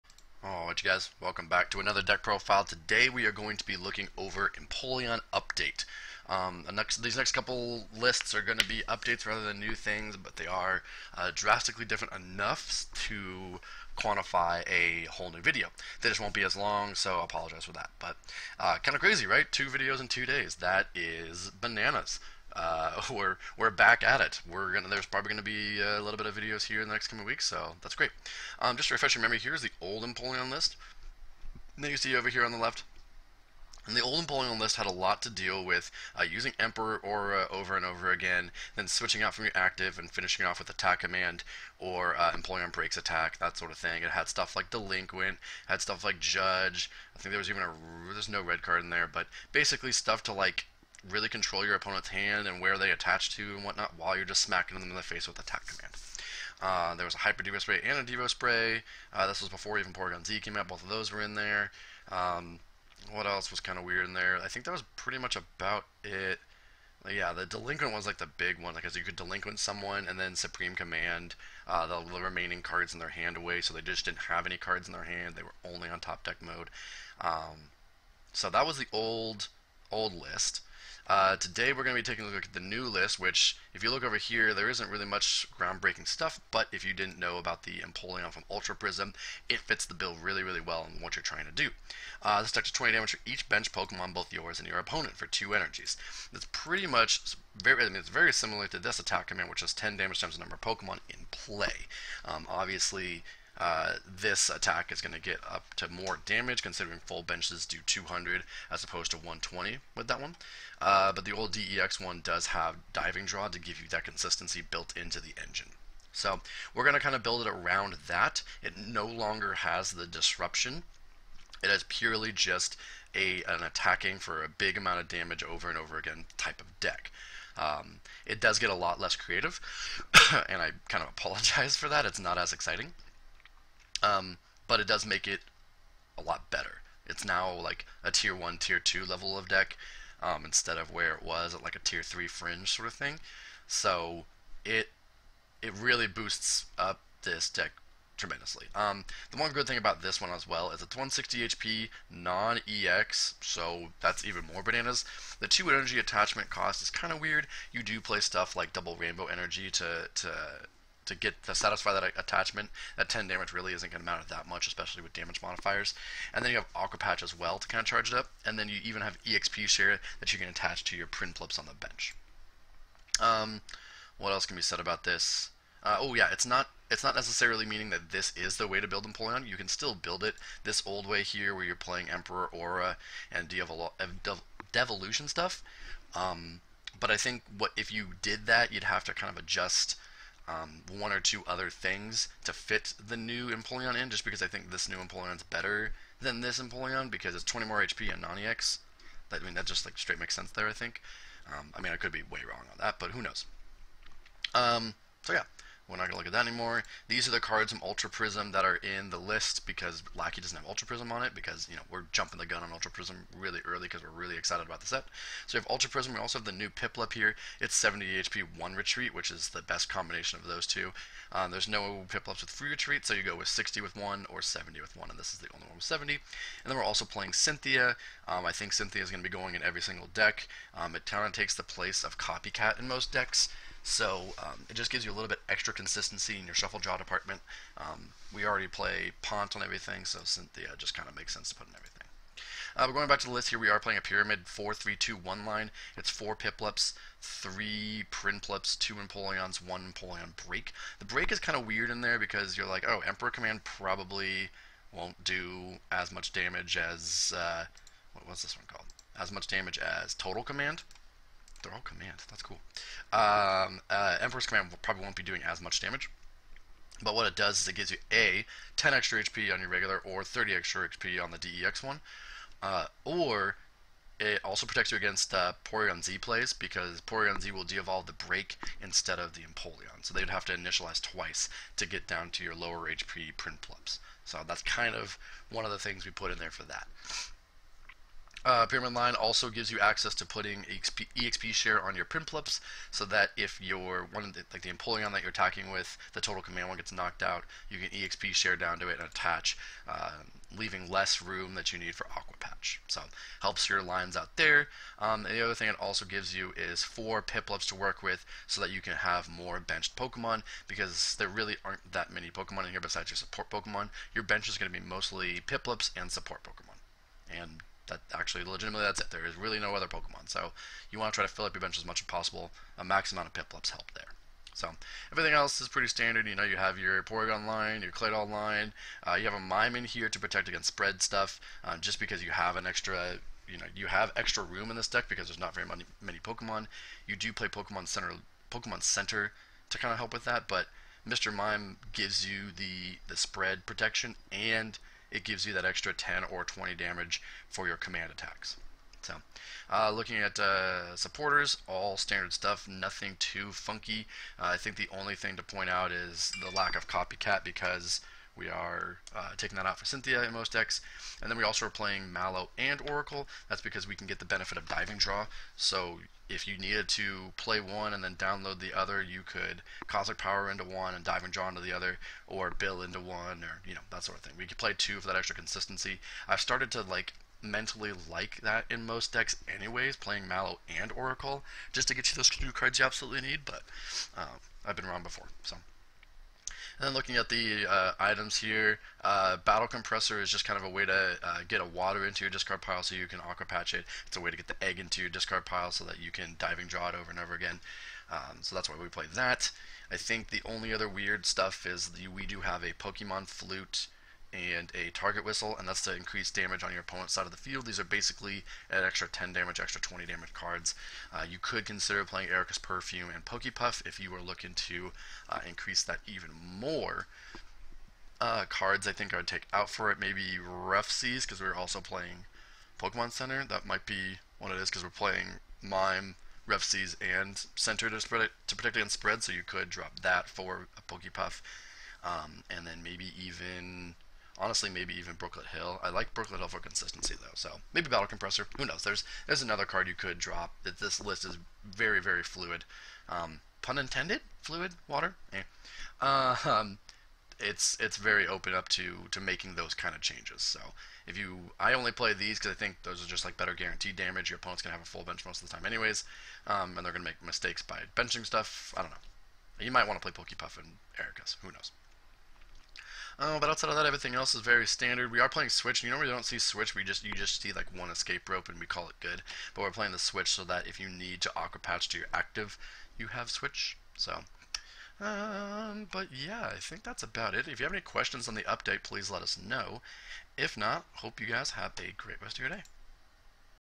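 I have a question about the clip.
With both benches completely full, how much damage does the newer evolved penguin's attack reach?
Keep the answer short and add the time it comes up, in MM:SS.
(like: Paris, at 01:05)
200, at 01:47.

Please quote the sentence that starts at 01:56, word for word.
So we're going to kind of build it around that.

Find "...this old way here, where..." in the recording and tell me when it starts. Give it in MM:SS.
03:00.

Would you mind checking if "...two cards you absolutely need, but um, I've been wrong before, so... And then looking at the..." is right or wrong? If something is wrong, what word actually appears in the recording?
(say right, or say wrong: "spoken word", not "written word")
right.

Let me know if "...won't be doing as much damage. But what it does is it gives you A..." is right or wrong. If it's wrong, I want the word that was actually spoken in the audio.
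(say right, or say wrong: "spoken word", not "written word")
right.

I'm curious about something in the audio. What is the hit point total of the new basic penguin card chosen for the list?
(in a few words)
70.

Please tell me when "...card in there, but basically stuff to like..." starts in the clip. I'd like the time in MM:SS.
00:48.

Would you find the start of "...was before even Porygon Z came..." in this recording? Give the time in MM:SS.
00:59.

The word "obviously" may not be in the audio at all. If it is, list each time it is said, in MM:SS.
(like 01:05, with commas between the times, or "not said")
01:42.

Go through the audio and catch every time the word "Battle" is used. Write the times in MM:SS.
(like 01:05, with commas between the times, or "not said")
06:29, 07:17.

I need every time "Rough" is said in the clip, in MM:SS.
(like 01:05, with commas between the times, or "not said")
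07:00, 07:06.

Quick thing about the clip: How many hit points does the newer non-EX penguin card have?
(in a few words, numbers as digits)
160.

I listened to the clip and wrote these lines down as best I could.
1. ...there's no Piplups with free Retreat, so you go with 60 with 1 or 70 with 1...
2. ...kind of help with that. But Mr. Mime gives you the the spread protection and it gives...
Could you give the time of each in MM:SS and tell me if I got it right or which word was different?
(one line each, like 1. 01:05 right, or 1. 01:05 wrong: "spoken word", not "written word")
1. 03:41 right
2. 05:39 right.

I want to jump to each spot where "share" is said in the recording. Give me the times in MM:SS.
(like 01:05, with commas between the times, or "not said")
02:49, 04:51, 04:58.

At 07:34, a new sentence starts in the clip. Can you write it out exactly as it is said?
Your opponent's gonna have a full bench most of the time, anyways, um, and they're gonna make mistakes by benching stuff.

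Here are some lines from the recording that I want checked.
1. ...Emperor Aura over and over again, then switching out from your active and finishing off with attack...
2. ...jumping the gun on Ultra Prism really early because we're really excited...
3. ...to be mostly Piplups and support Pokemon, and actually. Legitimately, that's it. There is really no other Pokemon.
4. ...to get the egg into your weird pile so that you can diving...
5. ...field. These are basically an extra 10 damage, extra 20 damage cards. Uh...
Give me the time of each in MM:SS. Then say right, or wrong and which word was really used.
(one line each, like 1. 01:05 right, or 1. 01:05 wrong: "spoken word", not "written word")
1. 00:36 right
2. 03:32 right
3. 05:14 right
4. 06:34 wrong: "discard", not "weird"
5. 06:47 right.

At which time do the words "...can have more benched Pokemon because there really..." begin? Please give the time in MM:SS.
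05:08.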